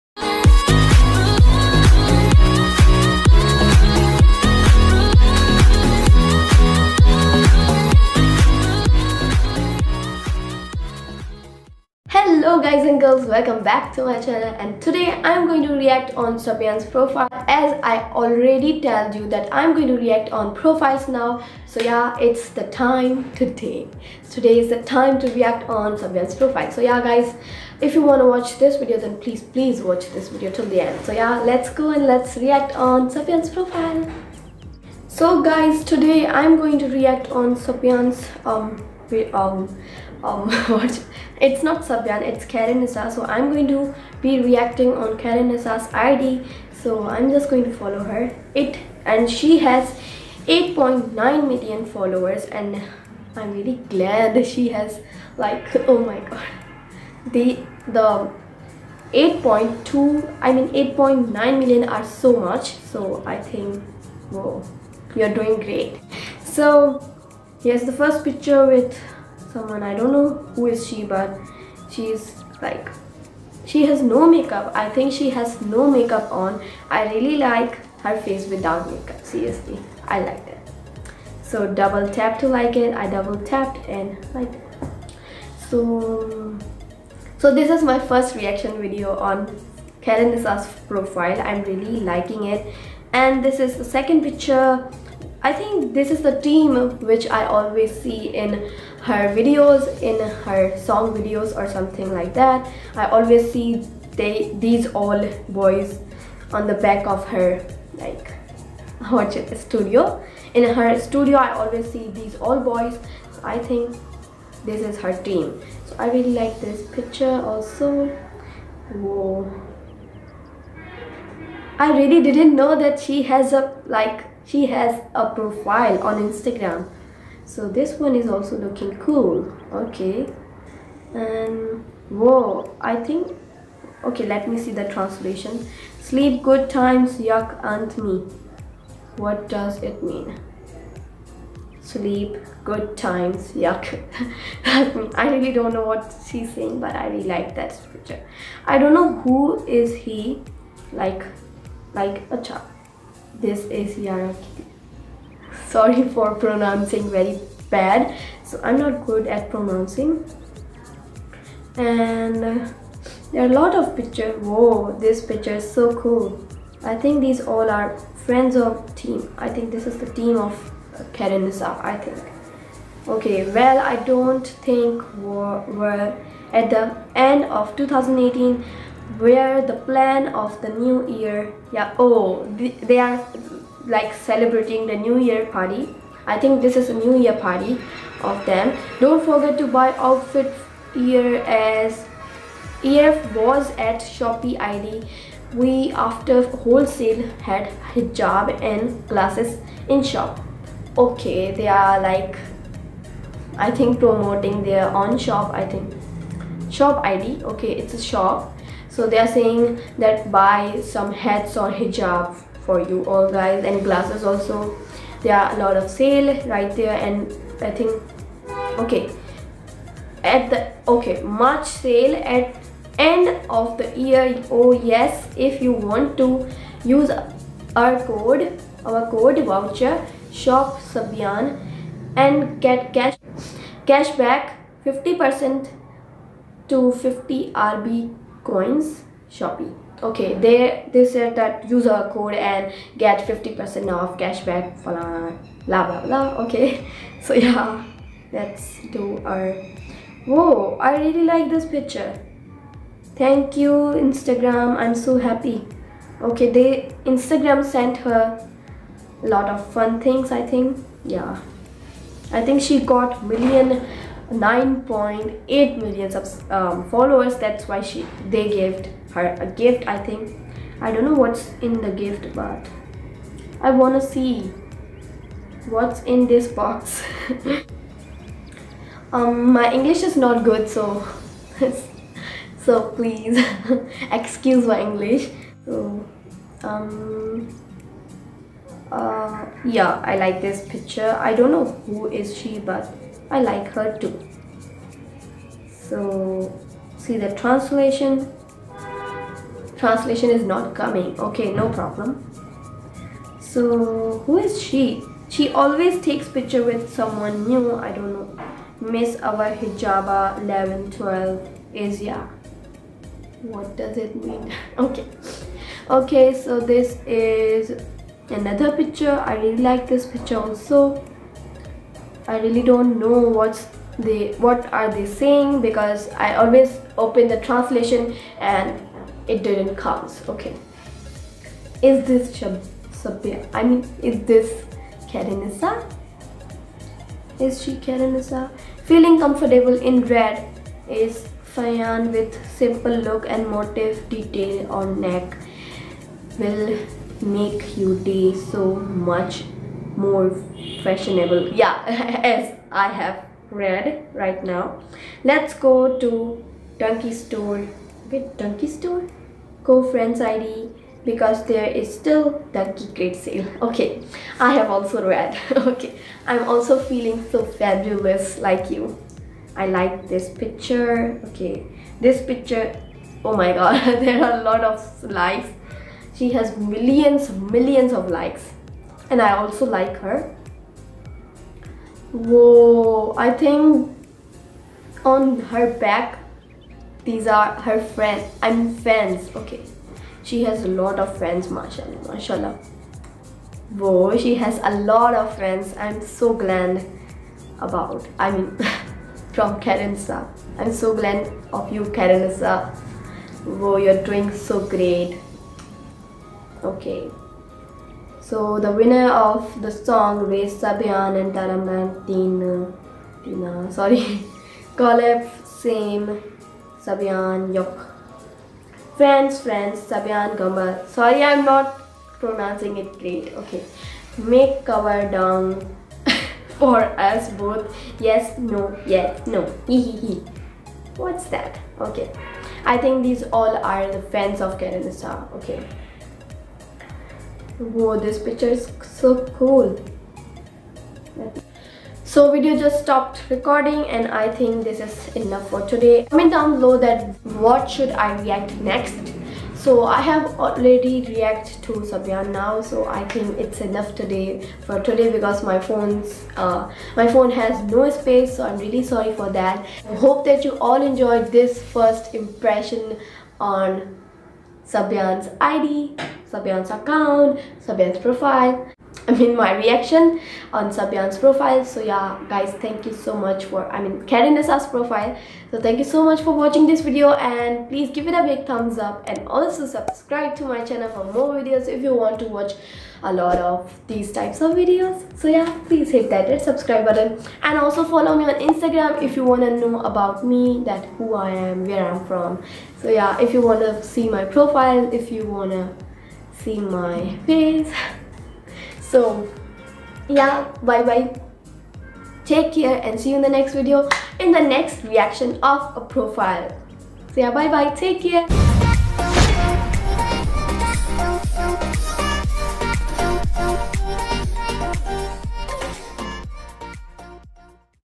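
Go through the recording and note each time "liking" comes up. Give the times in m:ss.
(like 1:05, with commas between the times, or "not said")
1:31.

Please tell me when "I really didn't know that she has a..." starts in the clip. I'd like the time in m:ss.
2:01.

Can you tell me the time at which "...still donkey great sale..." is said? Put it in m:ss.
6:01.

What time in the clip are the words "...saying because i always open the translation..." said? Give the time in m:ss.
5:25.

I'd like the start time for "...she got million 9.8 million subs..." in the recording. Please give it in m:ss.
4:22.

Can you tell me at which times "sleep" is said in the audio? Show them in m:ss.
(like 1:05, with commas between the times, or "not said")
2:16, 2:21.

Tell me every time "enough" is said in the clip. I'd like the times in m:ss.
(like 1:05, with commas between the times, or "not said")
7:25, 7:33.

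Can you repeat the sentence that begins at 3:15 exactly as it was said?
We after wholesale had hijab and glasses in shop.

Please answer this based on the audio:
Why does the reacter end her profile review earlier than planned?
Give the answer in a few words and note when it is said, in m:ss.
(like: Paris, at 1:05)
Phone has no space, at 7:36.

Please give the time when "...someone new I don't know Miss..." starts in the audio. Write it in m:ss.
5:06.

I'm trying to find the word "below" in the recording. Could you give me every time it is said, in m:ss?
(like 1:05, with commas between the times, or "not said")
7:26.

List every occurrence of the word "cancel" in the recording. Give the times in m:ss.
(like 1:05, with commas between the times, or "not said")
not said.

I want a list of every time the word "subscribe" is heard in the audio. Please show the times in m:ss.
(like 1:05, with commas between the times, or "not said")
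7:59, 8:06.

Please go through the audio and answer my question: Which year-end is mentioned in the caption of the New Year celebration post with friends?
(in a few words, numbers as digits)
2018.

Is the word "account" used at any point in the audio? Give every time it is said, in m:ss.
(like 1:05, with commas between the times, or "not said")
7:46.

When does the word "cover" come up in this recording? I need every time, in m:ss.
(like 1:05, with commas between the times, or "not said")
7:04.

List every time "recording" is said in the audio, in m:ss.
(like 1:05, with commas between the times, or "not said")
7:23.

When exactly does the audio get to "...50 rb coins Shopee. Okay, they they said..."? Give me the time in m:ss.
3:57.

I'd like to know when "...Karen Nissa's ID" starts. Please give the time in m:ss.
0:45.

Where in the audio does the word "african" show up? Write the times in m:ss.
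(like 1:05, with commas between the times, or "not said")
not said.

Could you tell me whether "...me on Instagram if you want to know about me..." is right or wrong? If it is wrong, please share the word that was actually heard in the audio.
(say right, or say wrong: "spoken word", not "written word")
right.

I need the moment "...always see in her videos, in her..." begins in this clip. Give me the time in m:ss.
1:37.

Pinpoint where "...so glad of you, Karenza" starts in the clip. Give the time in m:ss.
6:40.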